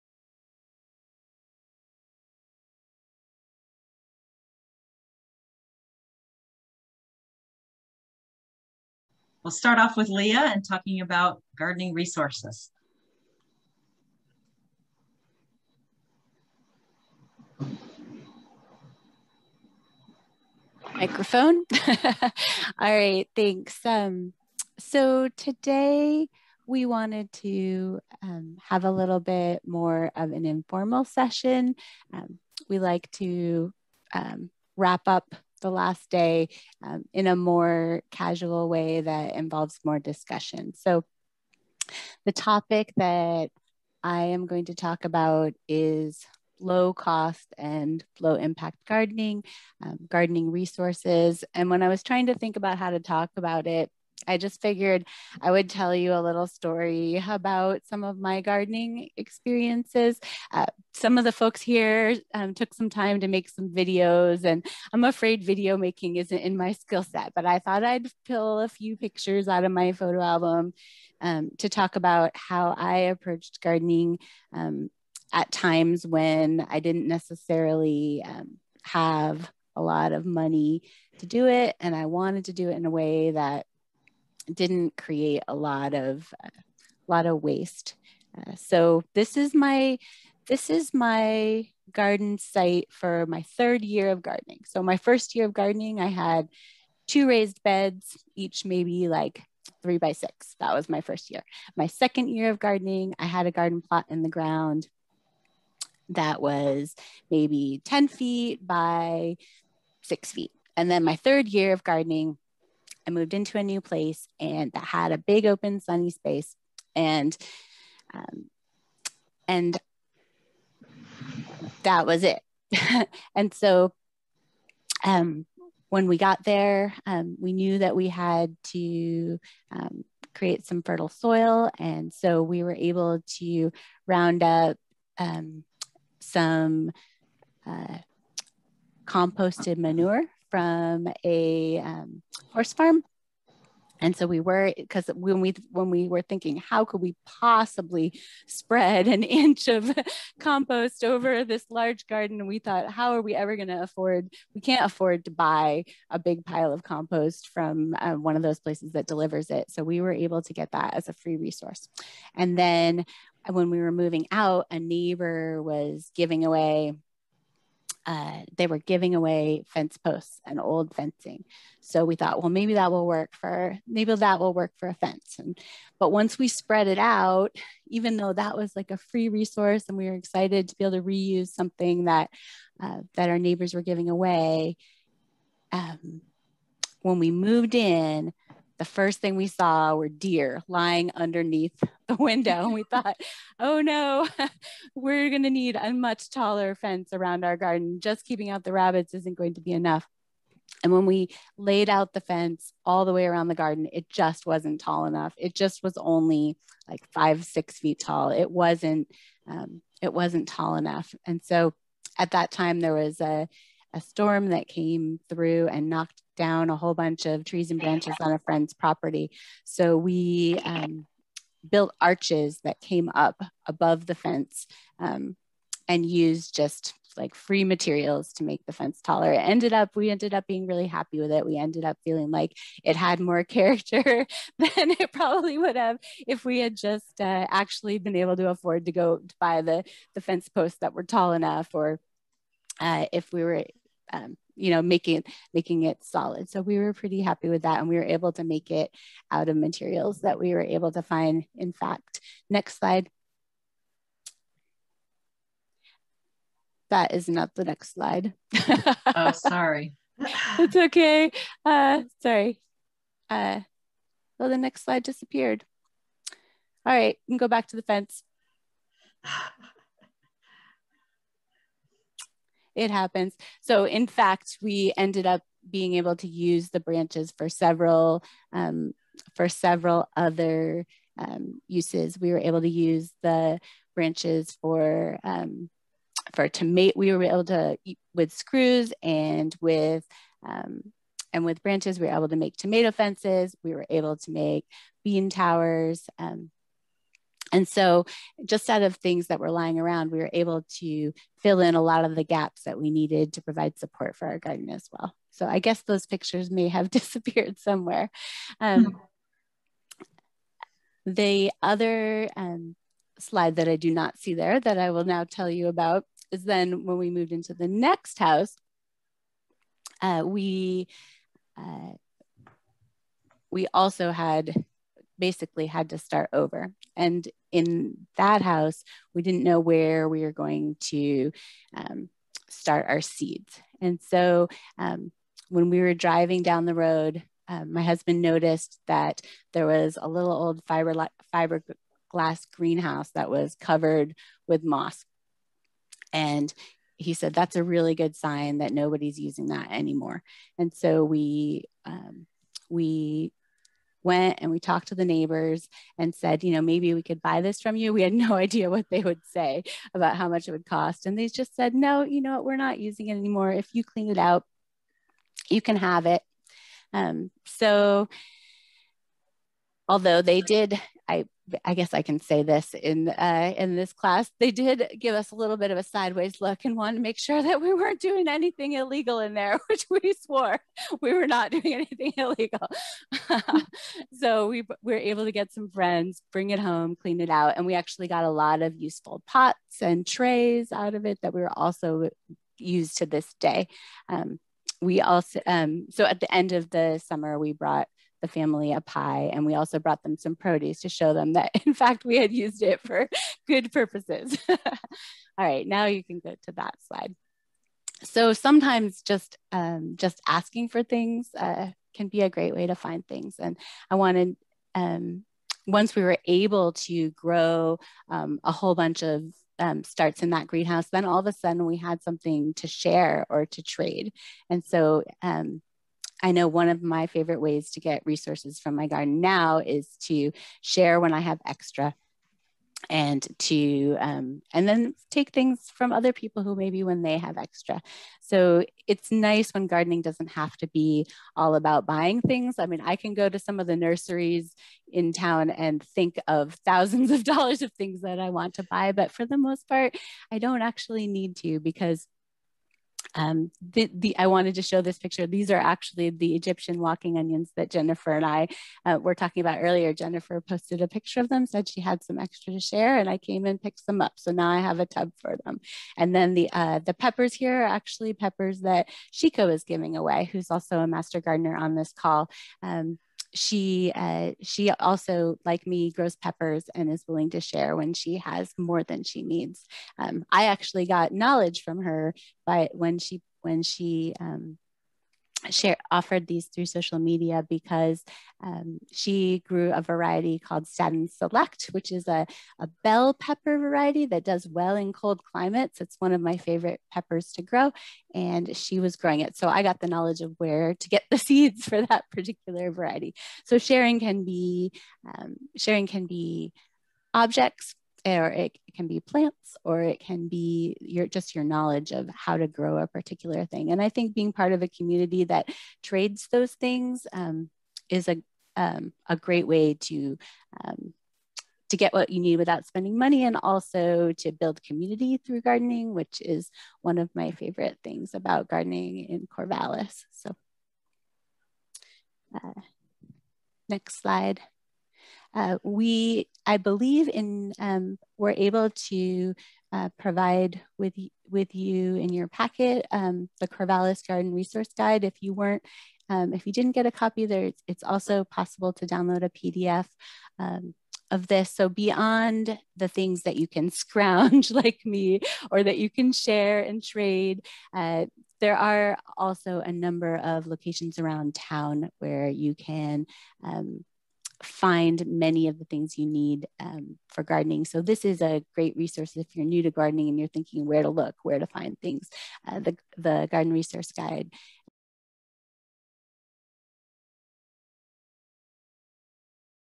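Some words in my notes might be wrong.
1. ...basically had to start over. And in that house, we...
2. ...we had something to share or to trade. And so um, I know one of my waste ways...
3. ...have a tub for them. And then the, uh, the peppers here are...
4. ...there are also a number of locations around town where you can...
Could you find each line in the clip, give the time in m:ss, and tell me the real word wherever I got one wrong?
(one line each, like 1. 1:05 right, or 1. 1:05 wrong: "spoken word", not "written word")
1. 5:25 right
2. 7:01 wrong: "favorite", not "waste"
3. 7:44 right
4. 9:18 right.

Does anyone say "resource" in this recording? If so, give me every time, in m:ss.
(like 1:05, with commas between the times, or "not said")
0:11, 0:50, 2:41, 2:59, 7:08, 9:04, 9:28, 9:33.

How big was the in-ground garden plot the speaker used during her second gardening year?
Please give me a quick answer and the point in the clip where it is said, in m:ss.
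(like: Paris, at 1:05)
10 feet by 6 feet, at 1:47.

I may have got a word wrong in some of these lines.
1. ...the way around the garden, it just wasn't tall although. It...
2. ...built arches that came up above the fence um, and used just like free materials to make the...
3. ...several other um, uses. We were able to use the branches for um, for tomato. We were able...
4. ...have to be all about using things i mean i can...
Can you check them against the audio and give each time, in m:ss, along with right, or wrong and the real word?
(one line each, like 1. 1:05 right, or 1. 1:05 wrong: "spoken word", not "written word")
1. 3:23 wrong: "enough", not "although"
2. 3:41 right
3. 4:39 right
4. 7:20 wrong: "buying", not "using".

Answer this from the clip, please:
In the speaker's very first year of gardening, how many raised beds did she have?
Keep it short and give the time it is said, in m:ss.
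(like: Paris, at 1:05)
2, at 1:37.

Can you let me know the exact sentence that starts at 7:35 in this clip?
These are actually the Egyptian walking onions that Jennifer and I uh, were talking about earlier.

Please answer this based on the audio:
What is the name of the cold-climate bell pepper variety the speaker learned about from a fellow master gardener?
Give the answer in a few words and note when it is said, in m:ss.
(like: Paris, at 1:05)
Staddon's Select, at 8:10.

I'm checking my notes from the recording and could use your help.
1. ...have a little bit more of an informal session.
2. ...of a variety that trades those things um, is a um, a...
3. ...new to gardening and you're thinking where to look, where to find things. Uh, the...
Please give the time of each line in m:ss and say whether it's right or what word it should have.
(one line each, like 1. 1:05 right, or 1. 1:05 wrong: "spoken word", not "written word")
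1. 0:28 right
2. 8:34 wrong: "community", not "variety"
3. 9:29 right.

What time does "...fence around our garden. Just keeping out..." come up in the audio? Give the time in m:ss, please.
3:16.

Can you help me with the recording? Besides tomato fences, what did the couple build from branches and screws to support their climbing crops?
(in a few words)
Bean towers.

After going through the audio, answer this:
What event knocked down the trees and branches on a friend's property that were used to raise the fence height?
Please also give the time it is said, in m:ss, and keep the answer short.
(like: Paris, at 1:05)
A storm, at 3:34.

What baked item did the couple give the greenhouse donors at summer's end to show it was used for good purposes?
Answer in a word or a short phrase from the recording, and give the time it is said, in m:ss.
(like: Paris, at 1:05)
A pie, at 6:38.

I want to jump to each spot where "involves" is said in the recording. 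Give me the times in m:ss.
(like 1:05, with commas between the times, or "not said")
0:39.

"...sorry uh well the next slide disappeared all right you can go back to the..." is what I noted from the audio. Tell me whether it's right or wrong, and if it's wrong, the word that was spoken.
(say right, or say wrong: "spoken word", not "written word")
right.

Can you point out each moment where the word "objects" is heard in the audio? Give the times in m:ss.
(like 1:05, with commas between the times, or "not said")
8:27.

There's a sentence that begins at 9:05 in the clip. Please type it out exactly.
If you weren't, um, if you didn't get a copy, there it's, it's also possible to download a PDF.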